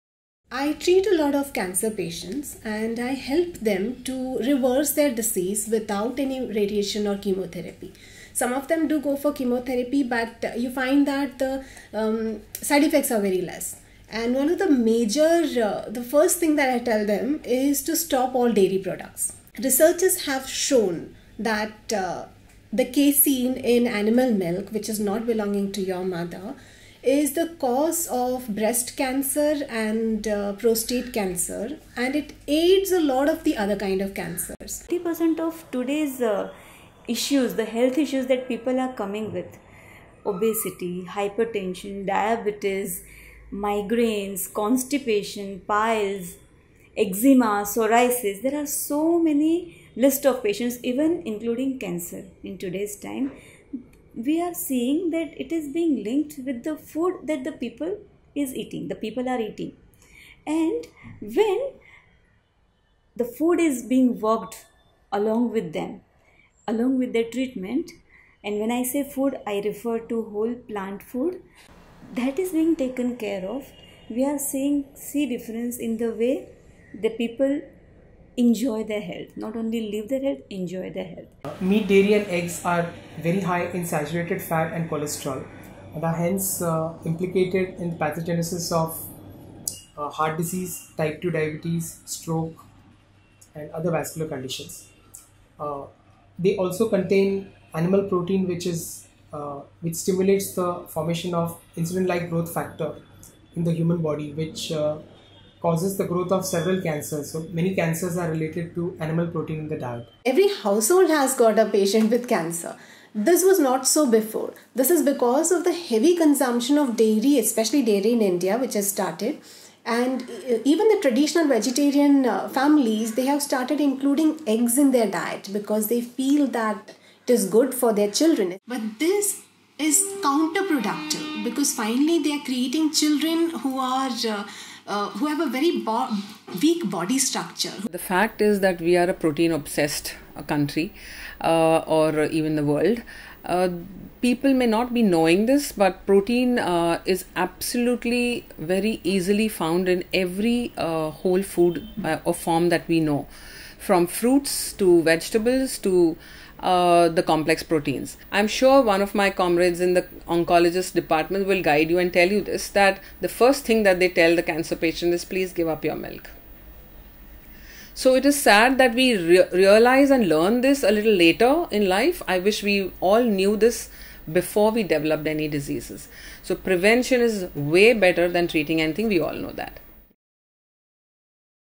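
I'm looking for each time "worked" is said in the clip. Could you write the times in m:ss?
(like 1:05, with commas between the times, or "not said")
1:04.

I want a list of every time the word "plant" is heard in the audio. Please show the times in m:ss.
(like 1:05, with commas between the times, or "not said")
1:10.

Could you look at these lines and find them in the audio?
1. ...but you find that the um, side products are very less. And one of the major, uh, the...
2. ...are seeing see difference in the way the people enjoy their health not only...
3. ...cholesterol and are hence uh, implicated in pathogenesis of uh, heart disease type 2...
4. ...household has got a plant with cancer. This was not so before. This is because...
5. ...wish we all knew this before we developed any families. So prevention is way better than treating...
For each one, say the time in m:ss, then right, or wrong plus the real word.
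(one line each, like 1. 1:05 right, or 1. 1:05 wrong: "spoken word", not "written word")
1. 0:10 wrong: "effects", not "products"
2. 1:14 right
3. 1:24 right
4. 1:50 wrong: "patient", not "plant"
5. 2:52 wrong: "diseases", not "families".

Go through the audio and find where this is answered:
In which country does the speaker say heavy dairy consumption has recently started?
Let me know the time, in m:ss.
1:58.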